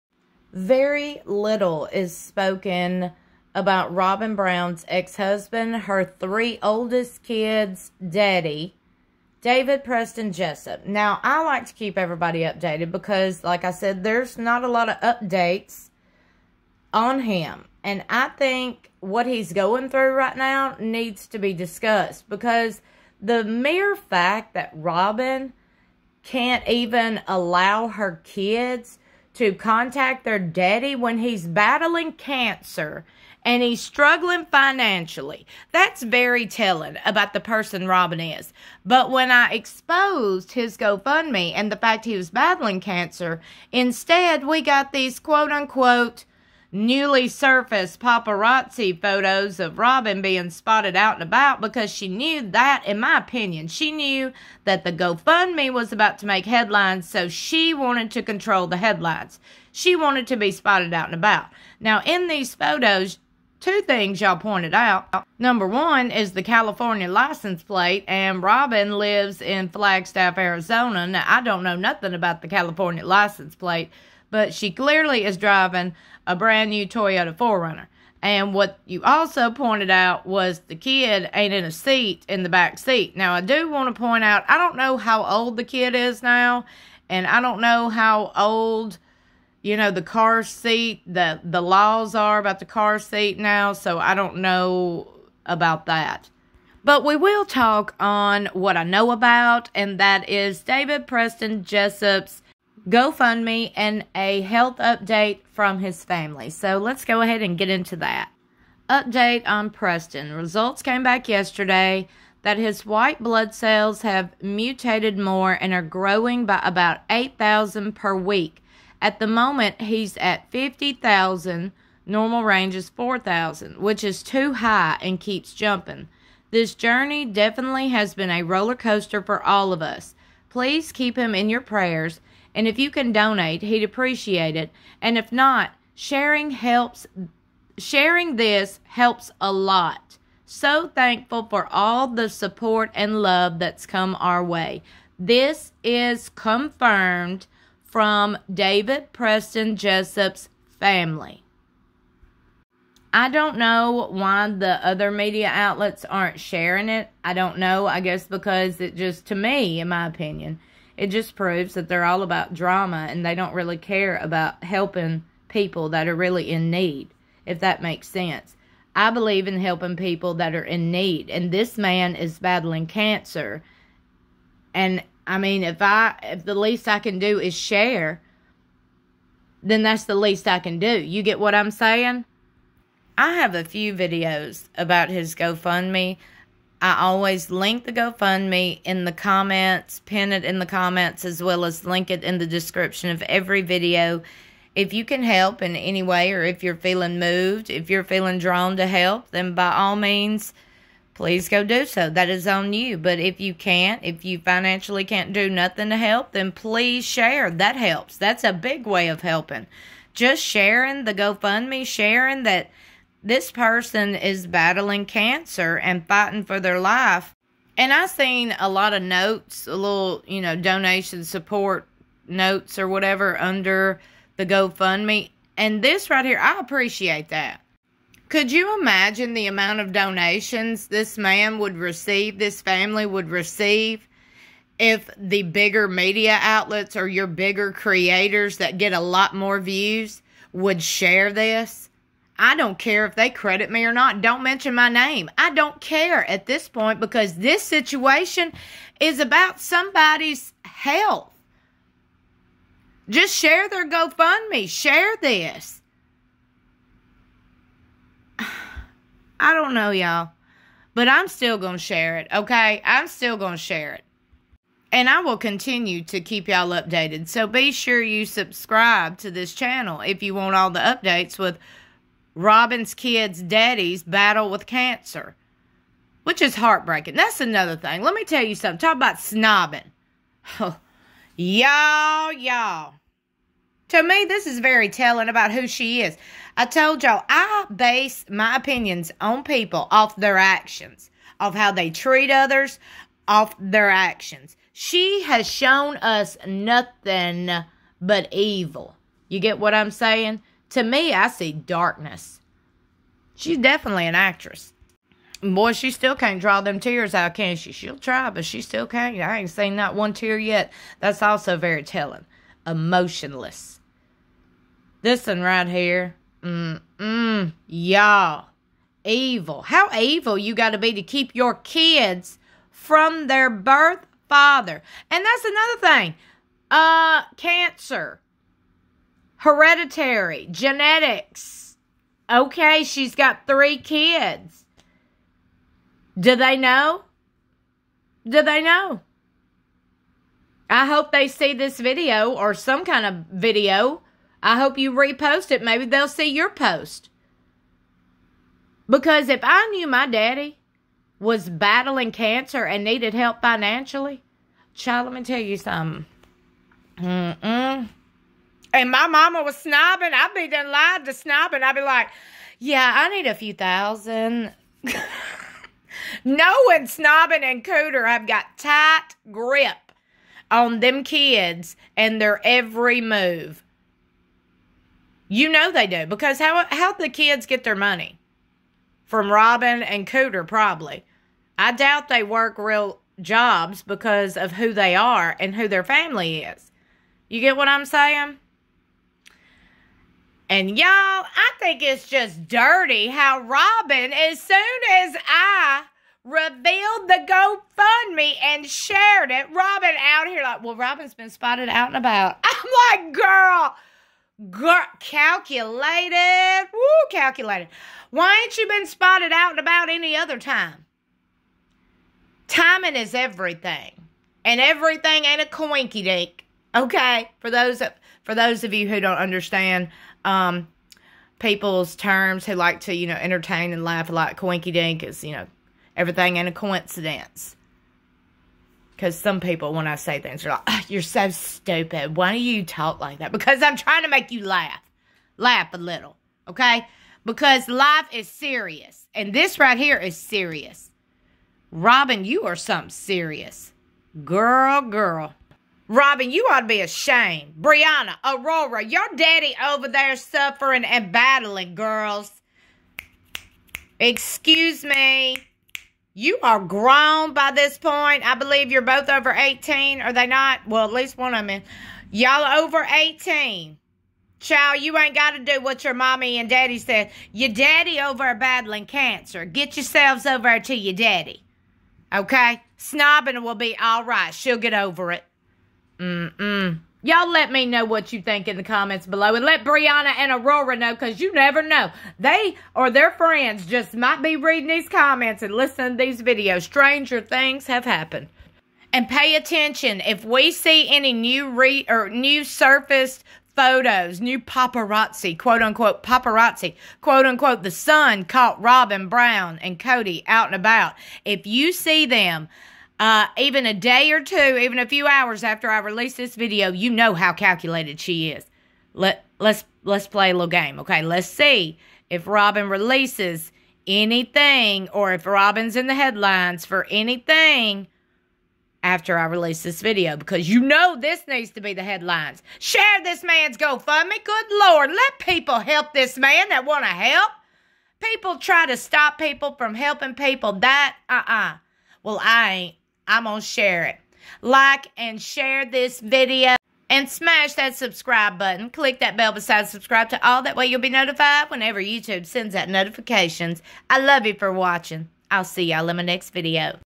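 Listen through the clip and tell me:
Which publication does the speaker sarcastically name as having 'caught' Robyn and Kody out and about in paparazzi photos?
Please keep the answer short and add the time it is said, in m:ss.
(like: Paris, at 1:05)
The Sun, at 8:17.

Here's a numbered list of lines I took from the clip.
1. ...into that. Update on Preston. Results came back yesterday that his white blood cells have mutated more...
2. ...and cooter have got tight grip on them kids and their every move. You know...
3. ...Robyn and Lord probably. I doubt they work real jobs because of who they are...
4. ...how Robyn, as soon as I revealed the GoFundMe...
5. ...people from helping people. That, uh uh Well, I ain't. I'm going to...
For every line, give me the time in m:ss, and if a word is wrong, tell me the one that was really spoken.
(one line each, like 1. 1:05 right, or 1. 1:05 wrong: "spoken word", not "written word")
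1. 1:47 right
2. 6:07 right
3. 6:19 wrong: "Cooter", not "Lord"
4. 6:33 right
5. 8:49 right.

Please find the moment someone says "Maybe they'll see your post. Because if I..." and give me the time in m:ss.
5:45.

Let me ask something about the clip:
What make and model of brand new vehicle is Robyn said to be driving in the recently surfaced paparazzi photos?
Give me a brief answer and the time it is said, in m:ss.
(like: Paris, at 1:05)
Toyota 4Runner, at 1:16.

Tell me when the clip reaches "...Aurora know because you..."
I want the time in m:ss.
8:00.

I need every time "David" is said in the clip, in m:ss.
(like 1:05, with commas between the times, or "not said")
0:09, 1:40, 2:28.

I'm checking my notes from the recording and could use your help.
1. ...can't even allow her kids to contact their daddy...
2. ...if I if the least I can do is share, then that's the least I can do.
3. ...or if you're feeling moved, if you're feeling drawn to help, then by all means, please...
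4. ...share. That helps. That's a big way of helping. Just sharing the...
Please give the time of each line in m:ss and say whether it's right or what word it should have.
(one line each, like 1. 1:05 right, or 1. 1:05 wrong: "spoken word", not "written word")
1. 0:26 right
2. 2:55 right
3. 3:16 right
4. 3:27 right.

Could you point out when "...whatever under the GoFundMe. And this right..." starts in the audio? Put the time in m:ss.
3:42.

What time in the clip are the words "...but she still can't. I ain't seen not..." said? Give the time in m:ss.
5:08.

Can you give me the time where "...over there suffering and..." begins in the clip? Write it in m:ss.
7:29.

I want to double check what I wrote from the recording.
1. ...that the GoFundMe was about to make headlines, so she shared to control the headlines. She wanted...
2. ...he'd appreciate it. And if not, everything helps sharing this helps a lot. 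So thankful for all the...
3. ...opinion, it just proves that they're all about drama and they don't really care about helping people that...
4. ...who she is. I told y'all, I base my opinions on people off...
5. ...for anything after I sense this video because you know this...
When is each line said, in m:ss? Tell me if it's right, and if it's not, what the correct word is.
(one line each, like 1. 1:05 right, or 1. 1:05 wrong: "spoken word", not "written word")
1. 0:54 wrong: "wanted", not "shared"
2. 2:13 wrong: "sharing", not "everything"
3. 2:40 right
4. 4:45 right
5. 8:36 wrong: "release", not "sense".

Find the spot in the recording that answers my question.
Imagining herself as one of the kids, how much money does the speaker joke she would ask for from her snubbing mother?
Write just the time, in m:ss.
6:03.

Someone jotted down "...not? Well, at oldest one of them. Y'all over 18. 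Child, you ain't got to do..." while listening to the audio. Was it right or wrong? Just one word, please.
wrong.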